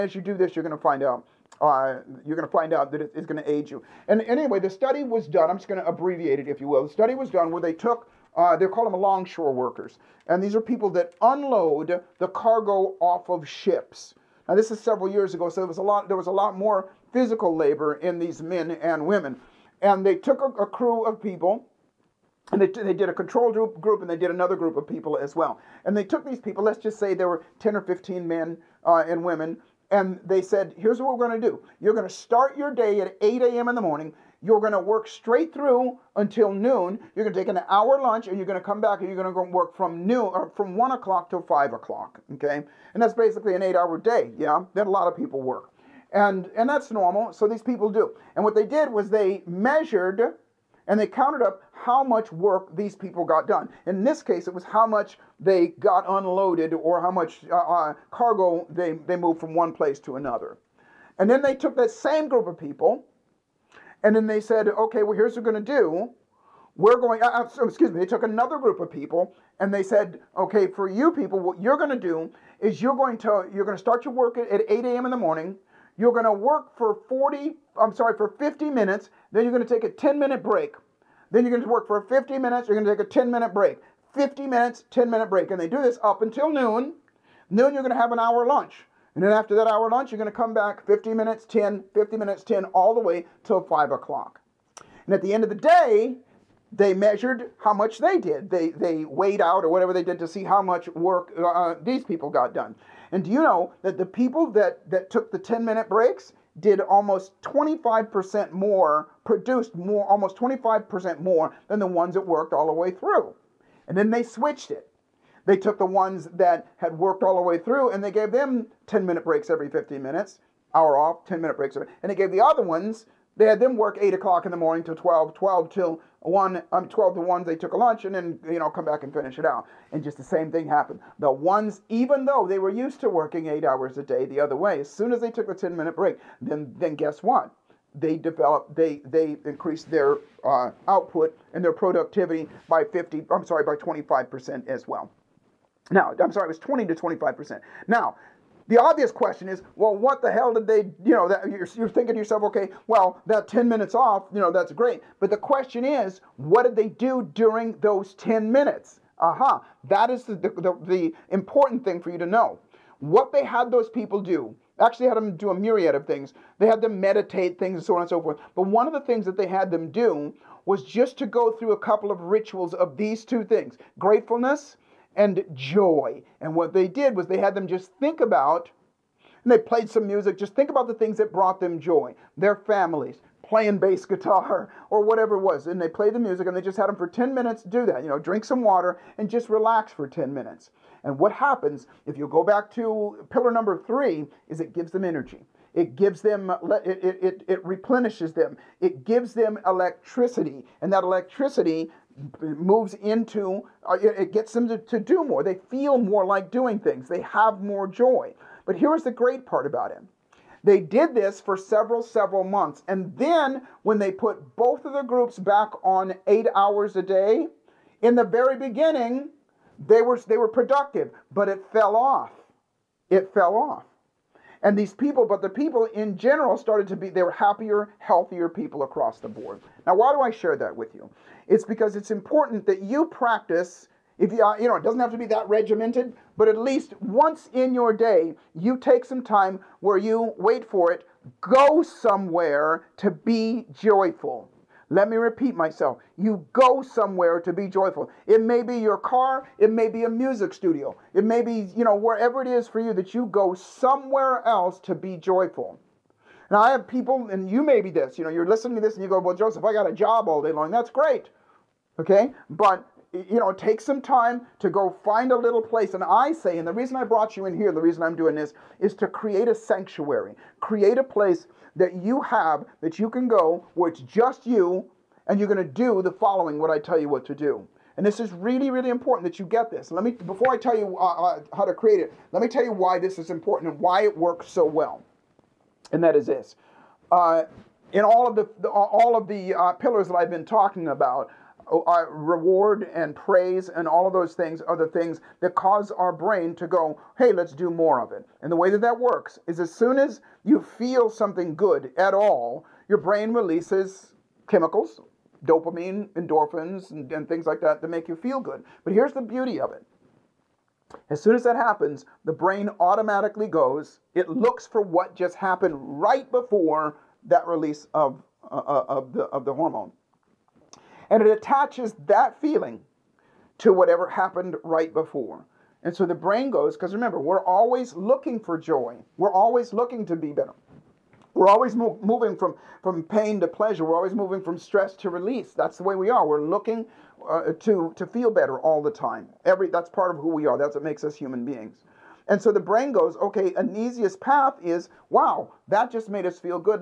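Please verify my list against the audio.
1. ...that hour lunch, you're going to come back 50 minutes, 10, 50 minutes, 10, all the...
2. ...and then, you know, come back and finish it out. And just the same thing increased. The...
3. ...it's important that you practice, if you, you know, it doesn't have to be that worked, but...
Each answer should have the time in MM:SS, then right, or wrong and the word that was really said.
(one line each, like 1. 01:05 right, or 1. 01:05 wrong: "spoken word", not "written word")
1. 01:29 right
2. 02:08 wrong: "happened", not "increased"
3. 03:51 wrong: "regimented", not "worked".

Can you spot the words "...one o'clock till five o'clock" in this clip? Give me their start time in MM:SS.
00:40.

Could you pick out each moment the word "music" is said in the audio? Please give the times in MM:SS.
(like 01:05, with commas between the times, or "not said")
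03:00, 03:06, 04:10.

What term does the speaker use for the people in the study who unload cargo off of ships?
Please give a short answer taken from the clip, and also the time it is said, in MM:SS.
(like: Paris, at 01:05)
longshore workers, at 00:08.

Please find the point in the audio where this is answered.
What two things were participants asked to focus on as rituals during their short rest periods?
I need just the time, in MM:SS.
02:53.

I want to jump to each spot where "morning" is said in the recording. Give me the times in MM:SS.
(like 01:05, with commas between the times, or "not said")
00:33, 01:15, 02:04.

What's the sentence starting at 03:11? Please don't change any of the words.
And what happens if you go back to pillar number three is it gives them energy.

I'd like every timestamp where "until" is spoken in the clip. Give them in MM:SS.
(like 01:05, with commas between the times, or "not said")
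00:36, 01:26.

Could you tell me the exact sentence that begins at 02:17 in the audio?
They developed, they, they increased their uh, output and their productivity by 50, I'm sorry, by 25% as well.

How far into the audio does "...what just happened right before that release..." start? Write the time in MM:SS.
05:14.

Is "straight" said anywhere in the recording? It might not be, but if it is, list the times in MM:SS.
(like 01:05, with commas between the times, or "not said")
00:35.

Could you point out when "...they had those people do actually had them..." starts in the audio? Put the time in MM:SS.
02:43.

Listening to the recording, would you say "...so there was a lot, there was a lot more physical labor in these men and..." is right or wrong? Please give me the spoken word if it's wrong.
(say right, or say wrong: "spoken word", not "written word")
right.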